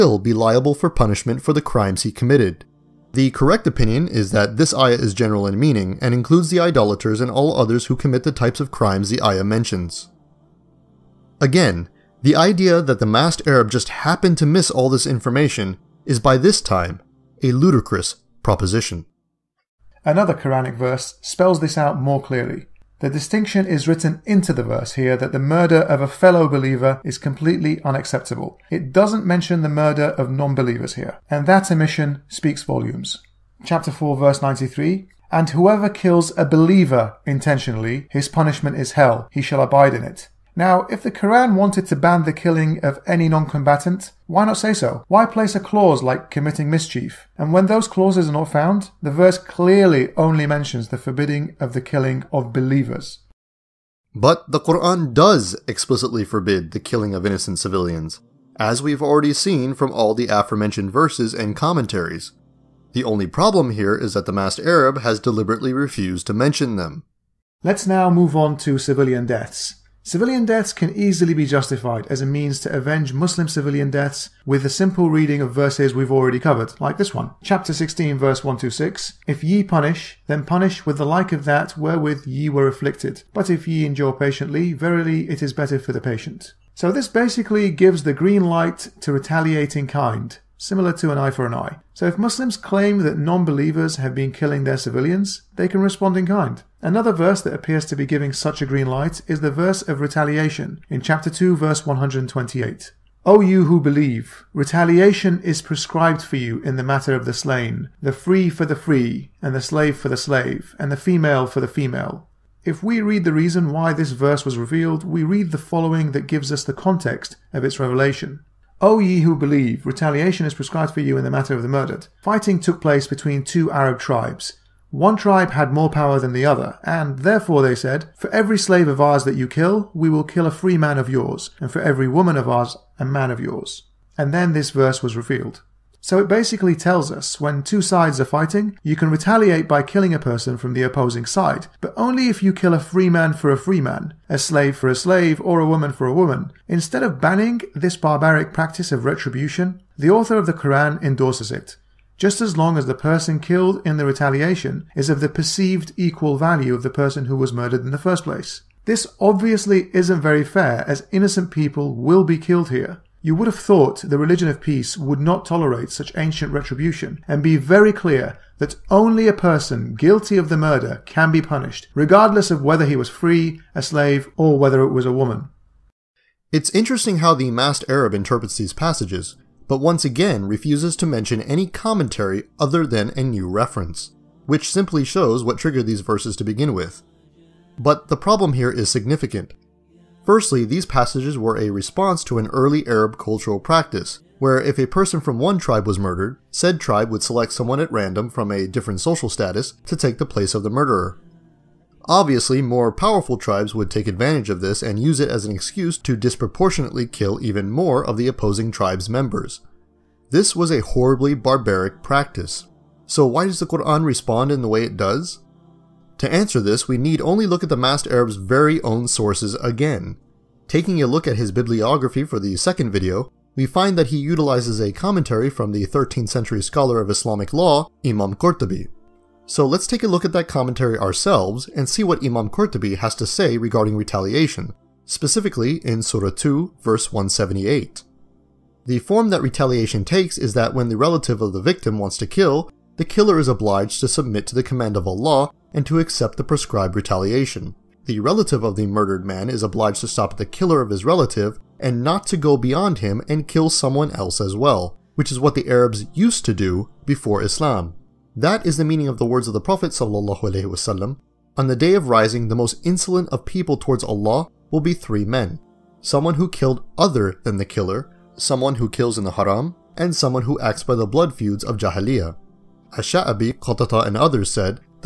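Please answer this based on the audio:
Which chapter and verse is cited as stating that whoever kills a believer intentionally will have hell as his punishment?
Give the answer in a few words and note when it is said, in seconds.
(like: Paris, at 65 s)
Chapter 4, verse 93, at 33 s.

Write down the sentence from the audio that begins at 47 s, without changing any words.
And when those clauses are not found, the verse clearly only mentions the forbidding of the killing of believers.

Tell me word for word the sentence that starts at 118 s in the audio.
O ye who believe, retaliation is prescribed for you in the matter of the murdered.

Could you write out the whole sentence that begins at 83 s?
But if ye endure patiently, verily it is better for the patient.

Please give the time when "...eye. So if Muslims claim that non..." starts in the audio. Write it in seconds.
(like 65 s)
91 s.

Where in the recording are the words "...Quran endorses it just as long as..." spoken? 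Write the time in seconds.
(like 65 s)
150 s.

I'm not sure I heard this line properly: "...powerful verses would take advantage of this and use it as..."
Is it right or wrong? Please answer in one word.
wrong.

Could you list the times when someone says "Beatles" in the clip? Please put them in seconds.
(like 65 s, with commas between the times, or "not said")
not said.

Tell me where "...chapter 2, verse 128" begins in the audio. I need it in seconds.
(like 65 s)
101 s.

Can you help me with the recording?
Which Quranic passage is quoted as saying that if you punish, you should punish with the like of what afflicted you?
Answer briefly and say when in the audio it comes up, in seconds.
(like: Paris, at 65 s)
Chapter 16, verse 126, at 77 s.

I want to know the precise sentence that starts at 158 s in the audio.
This obviously isn't very fair, as innocent people will be killed here.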